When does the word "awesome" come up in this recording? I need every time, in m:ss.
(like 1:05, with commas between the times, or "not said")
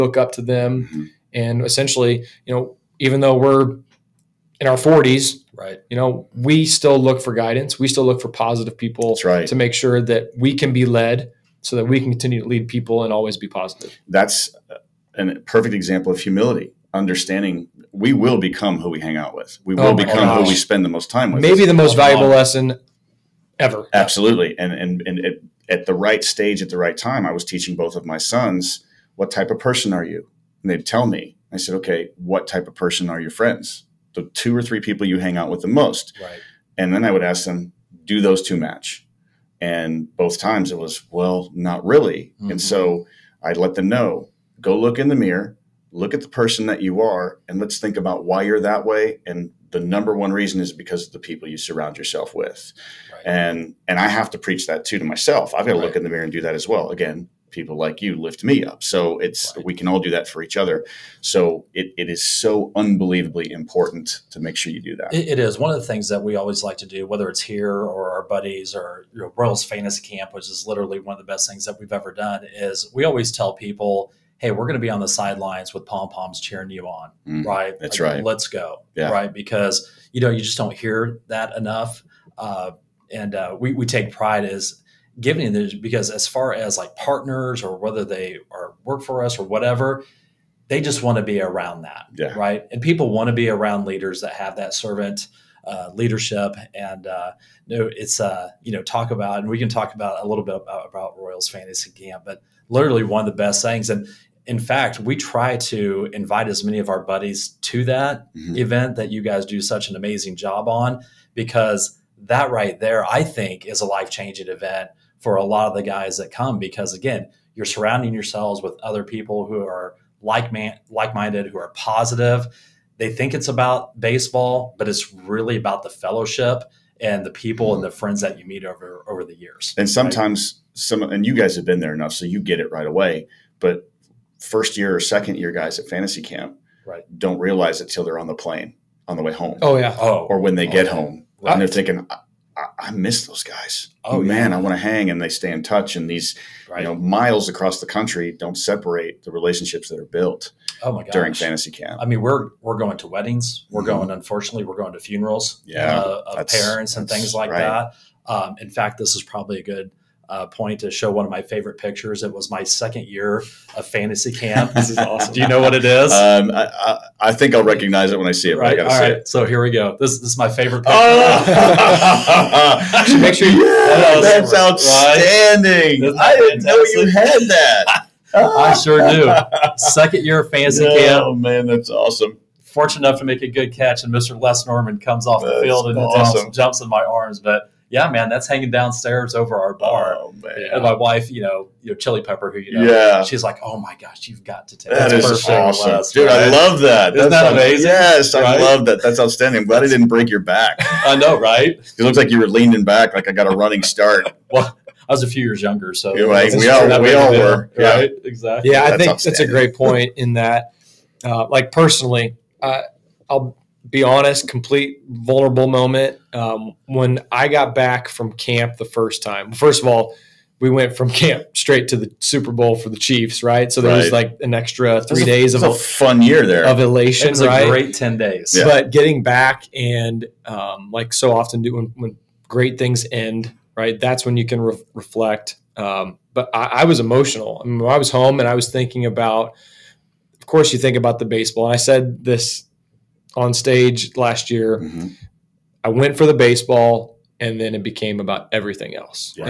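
2:44, 3:01, 3:05, 3:15.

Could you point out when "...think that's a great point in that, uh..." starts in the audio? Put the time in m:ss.
3:29.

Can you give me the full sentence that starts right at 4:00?
Of course, you think about the baseball.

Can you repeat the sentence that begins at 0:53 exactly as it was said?
and and i have to preach that too to myself i've got to right.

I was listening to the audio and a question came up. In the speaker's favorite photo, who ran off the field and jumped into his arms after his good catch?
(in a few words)
Les Norman.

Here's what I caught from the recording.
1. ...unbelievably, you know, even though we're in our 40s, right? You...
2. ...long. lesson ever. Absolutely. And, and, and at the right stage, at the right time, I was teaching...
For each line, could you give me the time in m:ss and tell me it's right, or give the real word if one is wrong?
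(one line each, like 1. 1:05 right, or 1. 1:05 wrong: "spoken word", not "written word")
1. 0:01 wrong: "essentially", not "unbelievably"
2. 0:22 right.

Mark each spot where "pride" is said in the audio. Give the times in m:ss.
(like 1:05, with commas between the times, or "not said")
1:24.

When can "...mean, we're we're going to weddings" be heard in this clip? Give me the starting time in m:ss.
2:32.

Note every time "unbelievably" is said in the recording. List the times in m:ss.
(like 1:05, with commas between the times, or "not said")
1:02.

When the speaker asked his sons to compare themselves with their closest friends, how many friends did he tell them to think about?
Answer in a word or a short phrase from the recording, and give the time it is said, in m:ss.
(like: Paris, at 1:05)
2 or 3, at 0:34.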